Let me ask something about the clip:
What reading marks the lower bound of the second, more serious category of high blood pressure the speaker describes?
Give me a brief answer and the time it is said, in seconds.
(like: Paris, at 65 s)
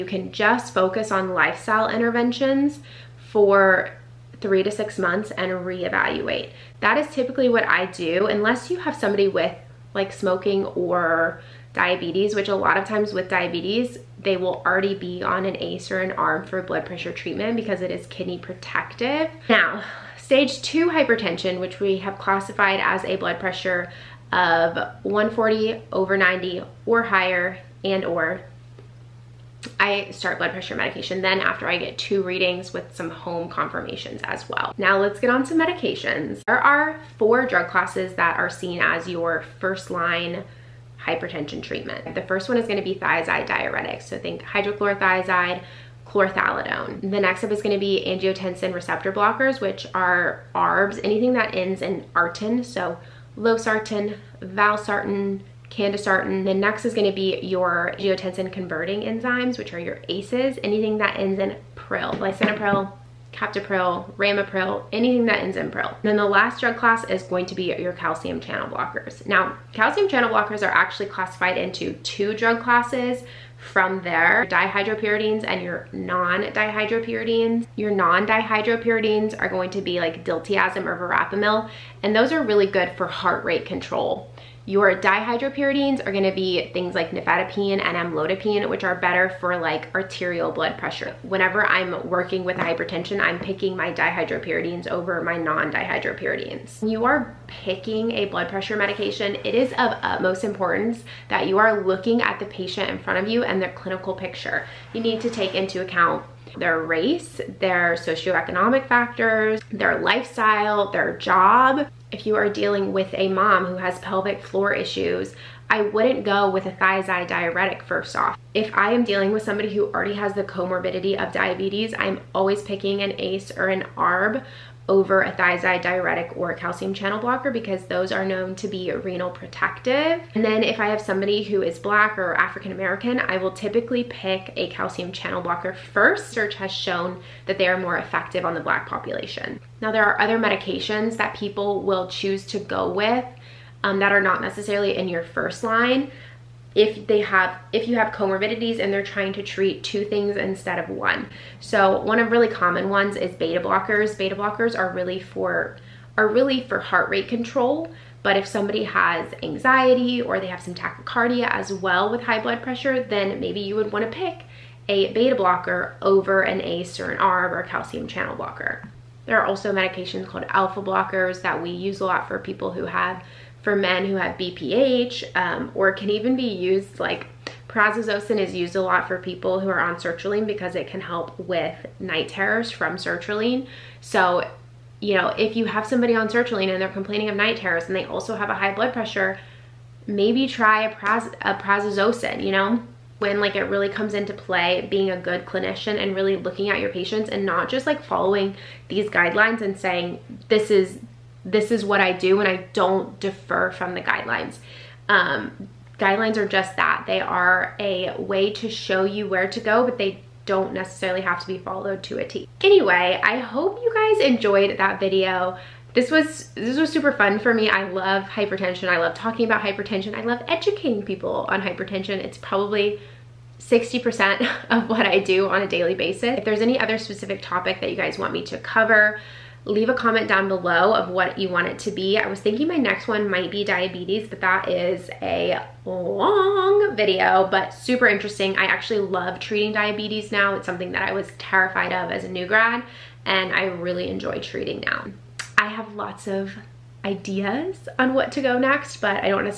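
140 over 90, at 25 s.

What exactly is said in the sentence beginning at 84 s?
Your dihydropyridines are gonna be things like nifedipine and amlodipine, which are better for like arterial blood pressure.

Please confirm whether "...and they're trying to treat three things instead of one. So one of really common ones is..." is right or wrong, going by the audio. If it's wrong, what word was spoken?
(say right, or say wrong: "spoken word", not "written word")
wrong: "two", not "three".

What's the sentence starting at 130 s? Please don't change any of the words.
And then if I have somebody who is black or African American, I will typically pick a calcium channel blocker first.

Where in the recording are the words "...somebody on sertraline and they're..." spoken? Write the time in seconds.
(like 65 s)
185 s.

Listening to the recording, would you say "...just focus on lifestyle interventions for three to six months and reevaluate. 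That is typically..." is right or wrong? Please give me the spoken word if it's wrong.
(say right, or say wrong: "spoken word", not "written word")
right.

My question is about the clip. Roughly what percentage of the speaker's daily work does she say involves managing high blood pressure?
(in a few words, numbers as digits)
60%.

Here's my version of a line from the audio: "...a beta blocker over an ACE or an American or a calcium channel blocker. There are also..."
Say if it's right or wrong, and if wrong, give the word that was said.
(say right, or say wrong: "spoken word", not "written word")
wrong: "ARB", not "American".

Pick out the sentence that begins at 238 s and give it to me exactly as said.
I actually love treating diabetes now.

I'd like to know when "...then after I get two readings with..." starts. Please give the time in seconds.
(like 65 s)
31 s.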